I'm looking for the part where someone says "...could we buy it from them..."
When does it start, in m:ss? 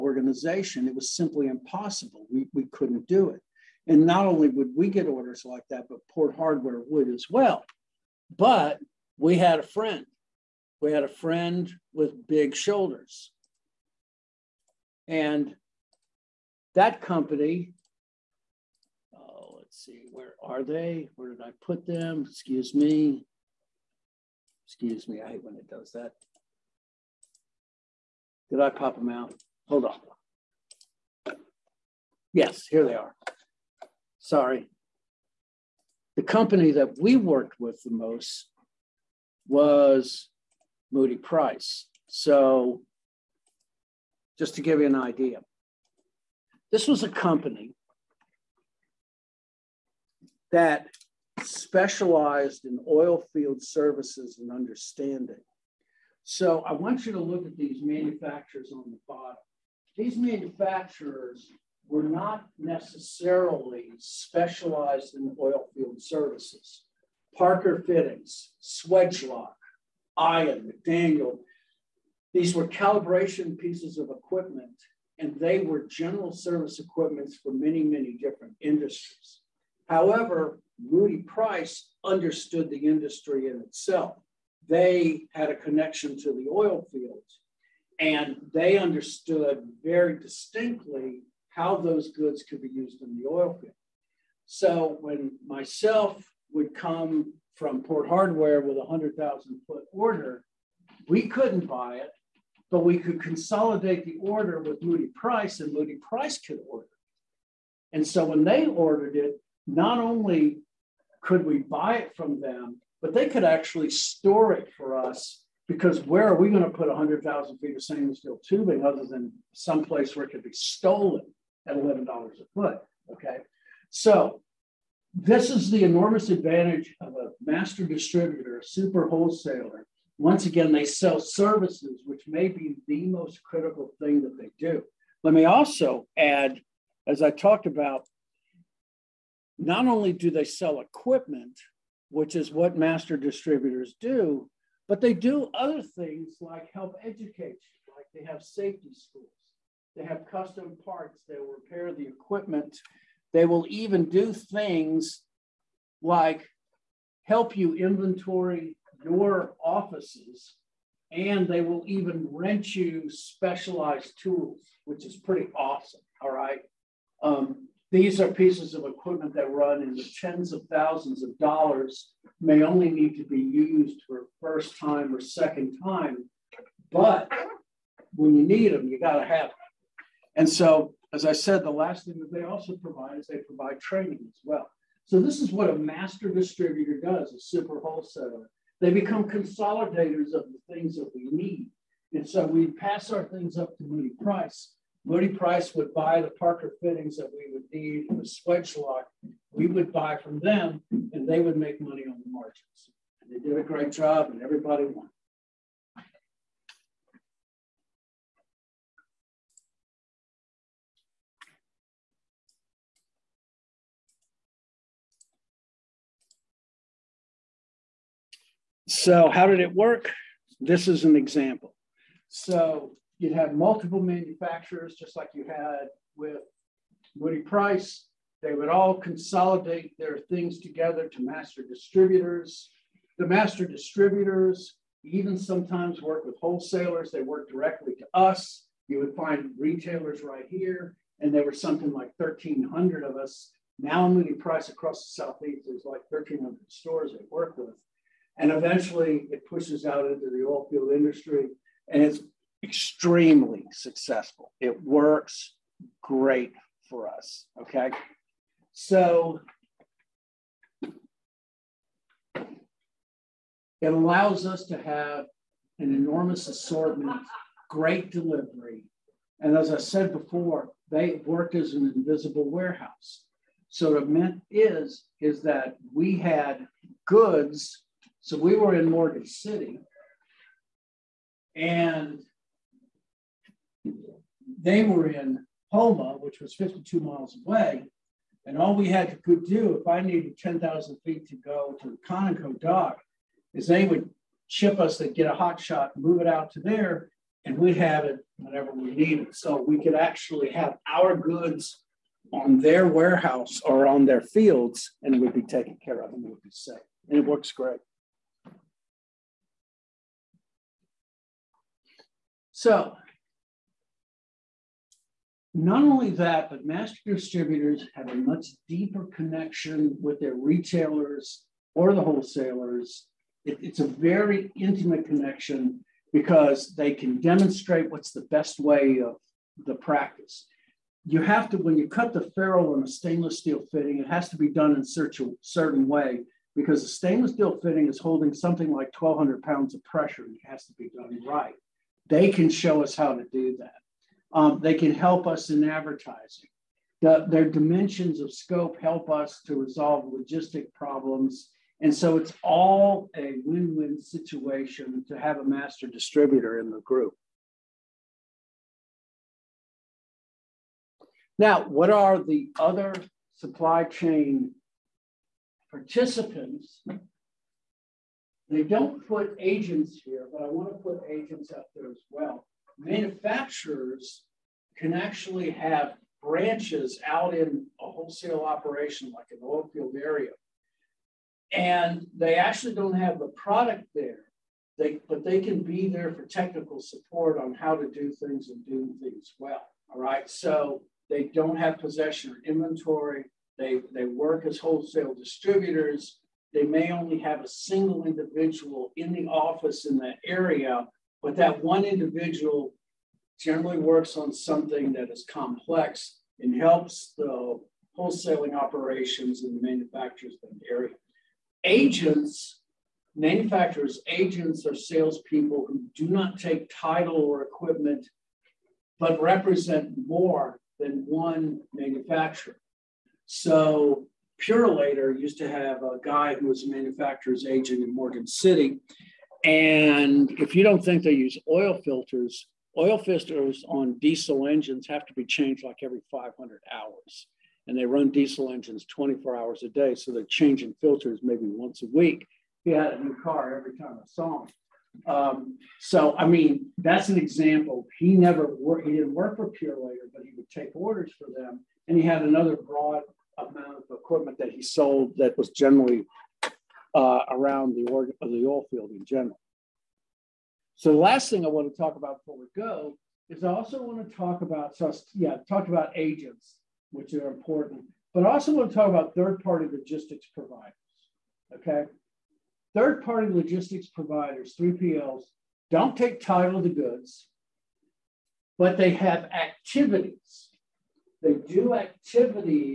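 1:51.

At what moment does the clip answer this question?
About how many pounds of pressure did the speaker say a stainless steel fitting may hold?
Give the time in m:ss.
5:38.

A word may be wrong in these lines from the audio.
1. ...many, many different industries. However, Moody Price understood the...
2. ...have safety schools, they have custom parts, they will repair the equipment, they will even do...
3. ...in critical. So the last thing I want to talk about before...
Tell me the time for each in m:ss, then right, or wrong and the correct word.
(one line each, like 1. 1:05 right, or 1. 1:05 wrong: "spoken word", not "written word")
1. 1:17 right
2. 2:28 right
3. 7:38 wrong: "general", not "critical".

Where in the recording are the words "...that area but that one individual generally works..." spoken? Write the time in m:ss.
6:39.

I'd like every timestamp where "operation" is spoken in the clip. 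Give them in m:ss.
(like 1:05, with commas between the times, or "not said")
6:18, 6:48.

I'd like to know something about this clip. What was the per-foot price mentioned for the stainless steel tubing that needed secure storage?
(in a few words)
$11.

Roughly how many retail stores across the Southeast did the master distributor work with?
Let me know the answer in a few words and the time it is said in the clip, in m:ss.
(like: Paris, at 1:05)
1,300, at 4:06.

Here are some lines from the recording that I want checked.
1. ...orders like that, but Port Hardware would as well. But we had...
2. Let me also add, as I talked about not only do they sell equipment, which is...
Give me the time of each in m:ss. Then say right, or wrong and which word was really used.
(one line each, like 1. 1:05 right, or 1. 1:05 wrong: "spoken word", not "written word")
1. 0:05 right
2. 2:15 right.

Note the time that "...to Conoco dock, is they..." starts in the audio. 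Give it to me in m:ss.
4:51.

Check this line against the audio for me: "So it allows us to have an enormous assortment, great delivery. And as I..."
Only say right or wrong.
right.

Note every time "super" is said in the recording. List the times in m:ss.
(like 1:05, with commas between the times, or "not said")
2:08, 3:07.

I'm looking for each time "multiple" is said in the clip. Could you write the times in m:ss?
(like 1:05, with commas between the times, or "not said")
3:43.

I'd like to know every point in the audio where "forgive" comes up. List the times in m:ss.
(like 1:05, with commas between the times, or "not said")
not said.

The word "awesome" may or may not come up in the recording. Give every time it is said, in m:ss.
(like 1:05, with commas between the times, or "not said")
2:45.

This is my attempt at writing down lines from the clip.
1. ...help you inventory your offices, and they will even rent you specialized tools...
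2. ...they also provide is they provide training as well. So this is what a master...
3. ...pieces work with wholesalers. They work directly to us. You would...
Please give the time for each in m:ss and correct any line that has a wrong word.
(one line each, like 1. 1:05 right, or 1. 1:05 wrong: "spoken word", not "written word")
1. 2:37 right
2. 3:02 right
3. 3:55 wrong: "sometimes", not "pieces".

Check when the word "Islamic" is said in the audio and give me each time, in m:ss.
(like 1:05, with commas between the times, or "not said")
not said.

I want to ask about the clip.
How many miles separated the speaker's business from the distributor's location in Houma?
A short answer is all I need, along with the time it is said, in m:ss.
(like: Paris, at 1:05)
52, at 4:46.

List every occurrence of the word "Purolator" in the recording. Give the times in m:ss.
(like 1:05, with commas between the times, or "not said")
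7:04, 7:29.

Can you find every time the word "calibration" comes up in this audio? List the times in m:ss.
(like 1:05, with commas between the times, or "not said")
1:12.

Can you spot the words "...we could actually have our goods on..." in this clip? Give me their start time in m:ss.
4:59.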